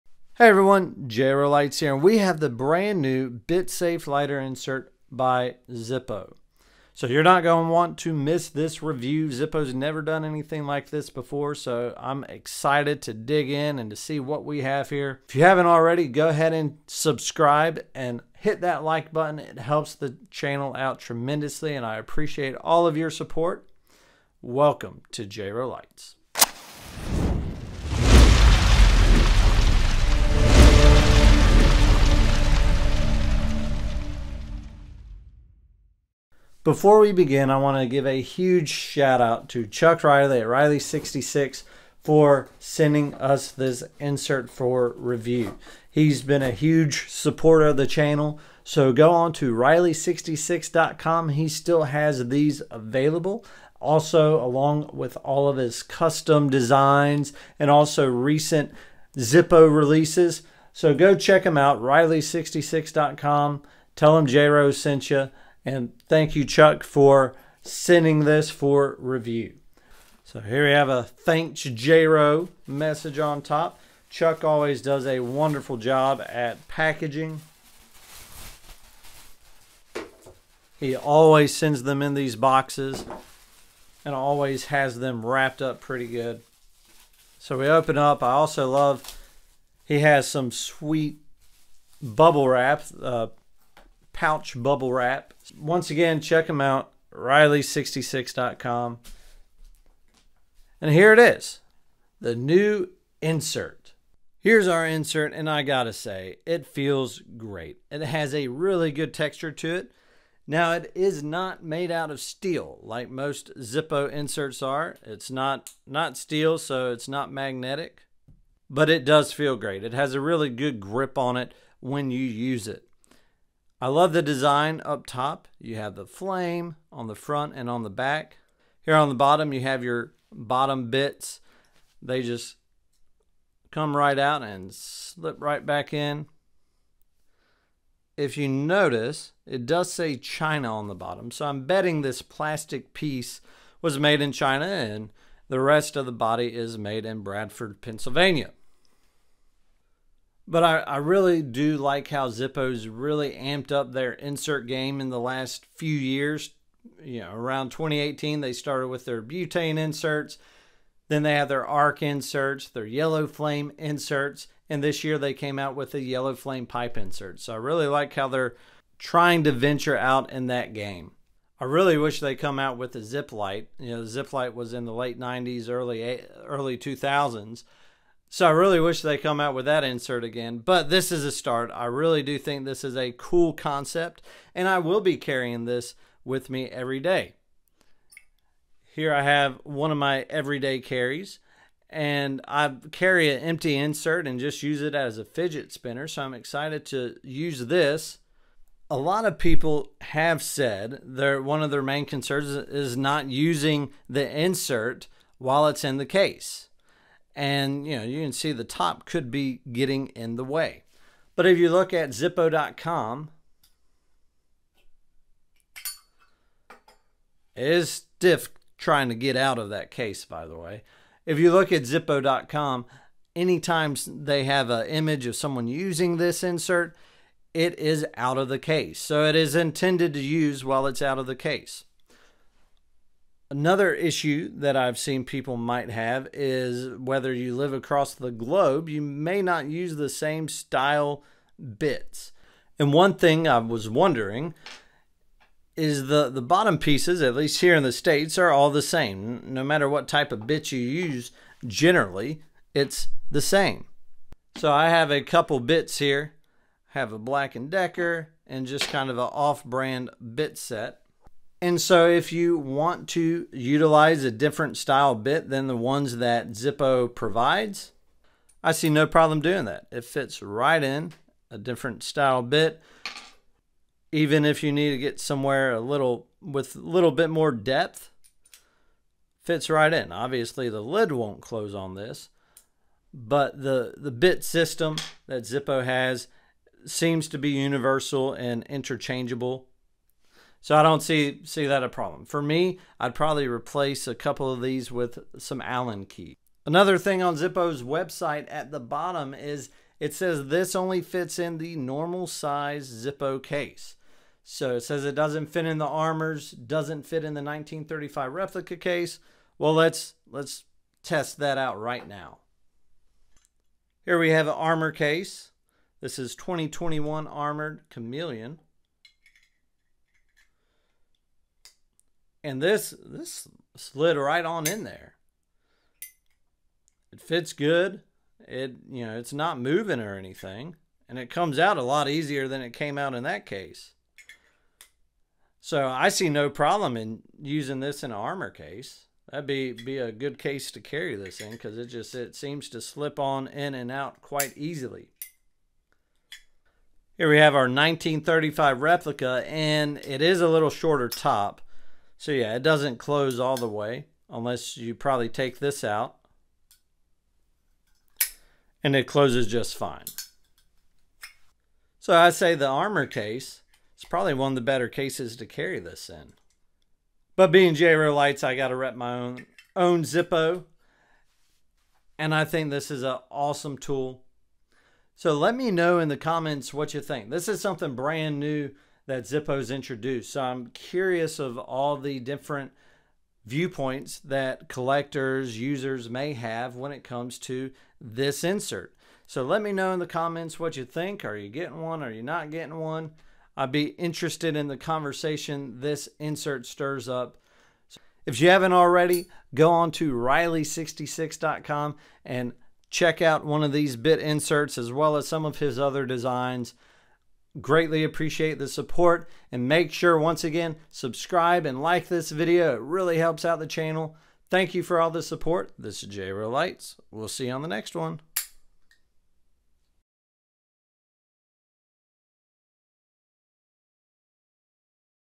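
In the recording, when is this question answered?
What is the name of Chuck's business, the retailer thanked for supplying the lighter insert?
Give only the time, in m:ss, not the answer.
0:40.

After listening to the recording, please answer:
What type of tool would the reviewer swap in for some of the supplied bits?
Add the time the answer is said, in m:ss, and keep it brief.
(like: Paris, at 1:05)
Allen key, at 4:55.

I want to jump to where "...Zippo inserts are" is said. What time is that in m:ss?
1:53.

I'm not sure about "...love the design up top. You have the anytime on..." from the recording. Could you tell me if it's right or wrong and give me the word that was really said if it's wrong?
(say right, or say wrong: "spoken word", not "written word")
wrong: "flame", not "anytime".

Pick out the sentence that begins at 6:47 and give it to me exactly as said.
Greatly appreciate the support and make sure once again, subscribe and like this video.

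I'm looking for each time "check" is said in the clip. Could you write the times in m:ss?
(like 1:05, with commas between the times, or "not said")
1:01, 1:36, 6:42.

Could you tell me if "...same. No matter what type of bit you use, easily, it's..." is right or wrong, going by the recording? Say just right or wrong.
wrong.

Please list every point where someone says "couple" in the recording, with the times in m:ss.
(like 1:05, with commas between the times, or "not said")
4:15, 4:54.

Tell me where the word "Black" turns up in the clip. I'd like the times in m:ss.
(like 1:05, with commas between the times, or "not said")
4:17.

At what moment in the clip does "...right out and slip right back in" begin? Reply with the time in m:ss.
2:13.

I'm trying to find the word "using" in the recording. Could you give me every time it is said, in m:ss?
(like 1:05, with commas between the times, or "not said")
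3:23, 3:45, 5:37.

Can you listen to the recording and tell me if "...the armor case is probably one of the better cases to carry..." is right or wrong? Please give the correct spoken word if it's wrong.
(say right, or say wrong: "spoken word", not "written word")
right.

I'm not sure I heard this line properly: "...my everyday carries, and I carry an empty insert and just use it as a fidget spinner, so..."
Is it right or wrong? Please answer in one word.
right.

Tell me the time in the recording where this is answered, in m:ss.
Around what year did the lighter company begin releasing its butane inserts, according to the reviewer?
2:37.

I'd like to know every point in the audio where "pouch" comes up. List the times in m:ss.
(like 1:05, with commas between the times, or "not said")
1:34.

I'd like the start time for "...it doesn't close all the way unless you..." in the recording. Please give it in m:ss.
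5:52.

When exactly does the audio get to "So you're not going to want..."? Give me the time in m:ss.
0:06.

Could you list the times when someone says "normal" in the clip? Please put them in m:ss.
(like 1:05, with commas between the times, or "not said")
5:01.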